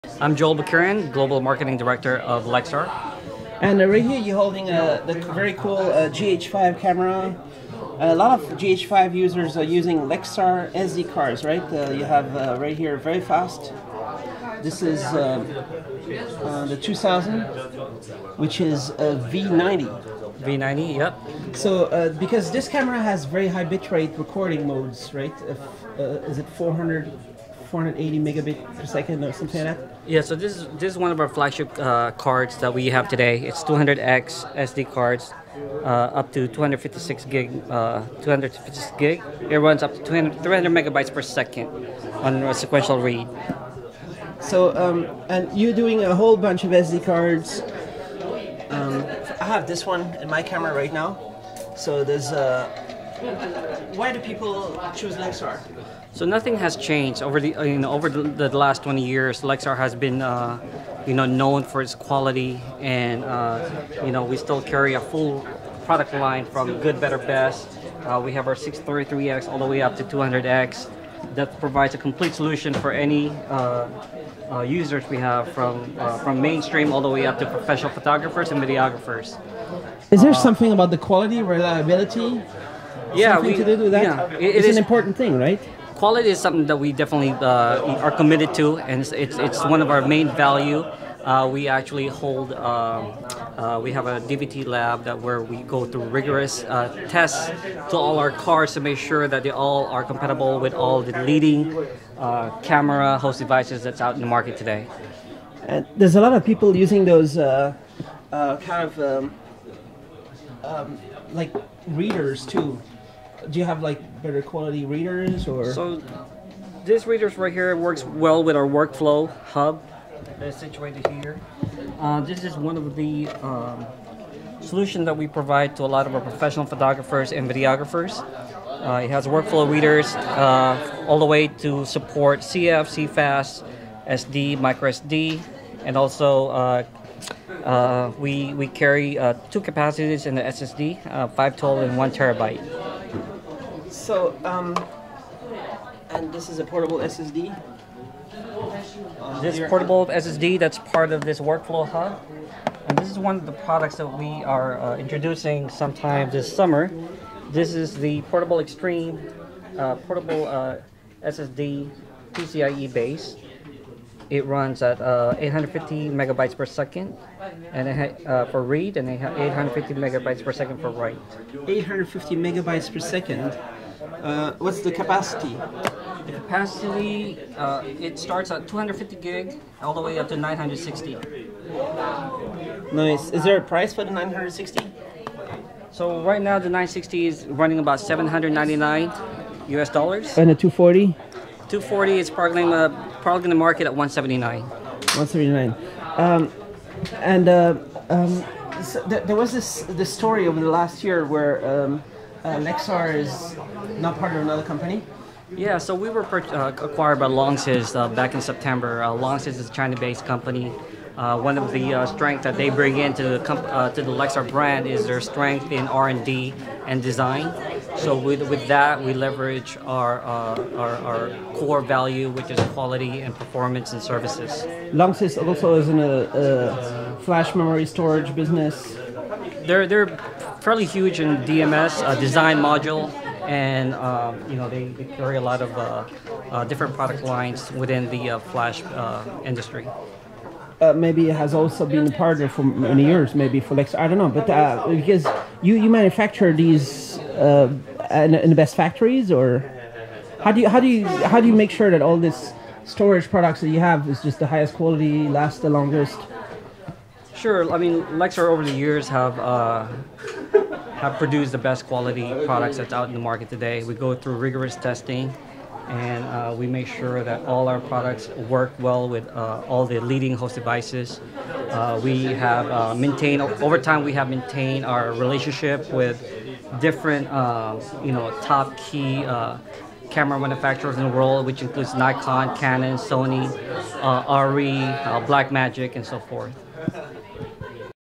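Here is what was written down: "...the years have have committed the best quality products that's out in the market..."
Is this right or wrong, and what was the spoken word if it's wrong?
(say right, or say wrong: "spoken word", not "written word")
wrong: "produced", not "committed".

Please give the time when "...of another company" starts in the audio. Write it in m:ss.
3:24.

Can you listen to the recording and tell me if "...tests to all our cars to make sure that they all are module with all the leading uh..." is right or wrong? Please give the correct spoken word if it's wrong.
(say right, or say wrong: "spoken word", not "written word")
wrong: "compatible", not "module".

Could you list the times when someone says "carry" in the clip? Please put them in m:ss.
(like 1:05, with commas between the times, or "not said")
1:04, 2:18, 3:55.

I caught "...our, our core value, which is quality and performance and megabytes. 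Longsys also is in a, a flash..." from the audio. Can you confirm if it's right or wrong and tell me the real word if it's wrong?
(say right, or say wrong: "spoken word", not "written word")
wrong: "services", not "megabytes".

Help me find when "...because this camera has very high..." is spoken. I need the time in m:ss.
0:22.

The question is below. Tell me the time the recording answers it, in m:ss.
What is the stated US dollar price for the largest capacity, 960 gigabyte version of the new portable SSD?
3:07.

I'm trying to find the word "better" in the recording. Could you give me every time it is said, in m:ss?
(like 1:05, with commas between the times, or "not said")
1:06, 1:54.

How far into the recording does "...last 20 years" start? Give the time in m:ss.
0:58.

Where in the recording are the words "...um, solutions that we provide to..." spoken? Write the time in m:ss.
2:03.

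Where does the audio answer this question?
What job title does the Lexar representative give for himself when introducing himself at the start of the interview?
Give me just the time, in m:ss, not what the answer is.
0:01.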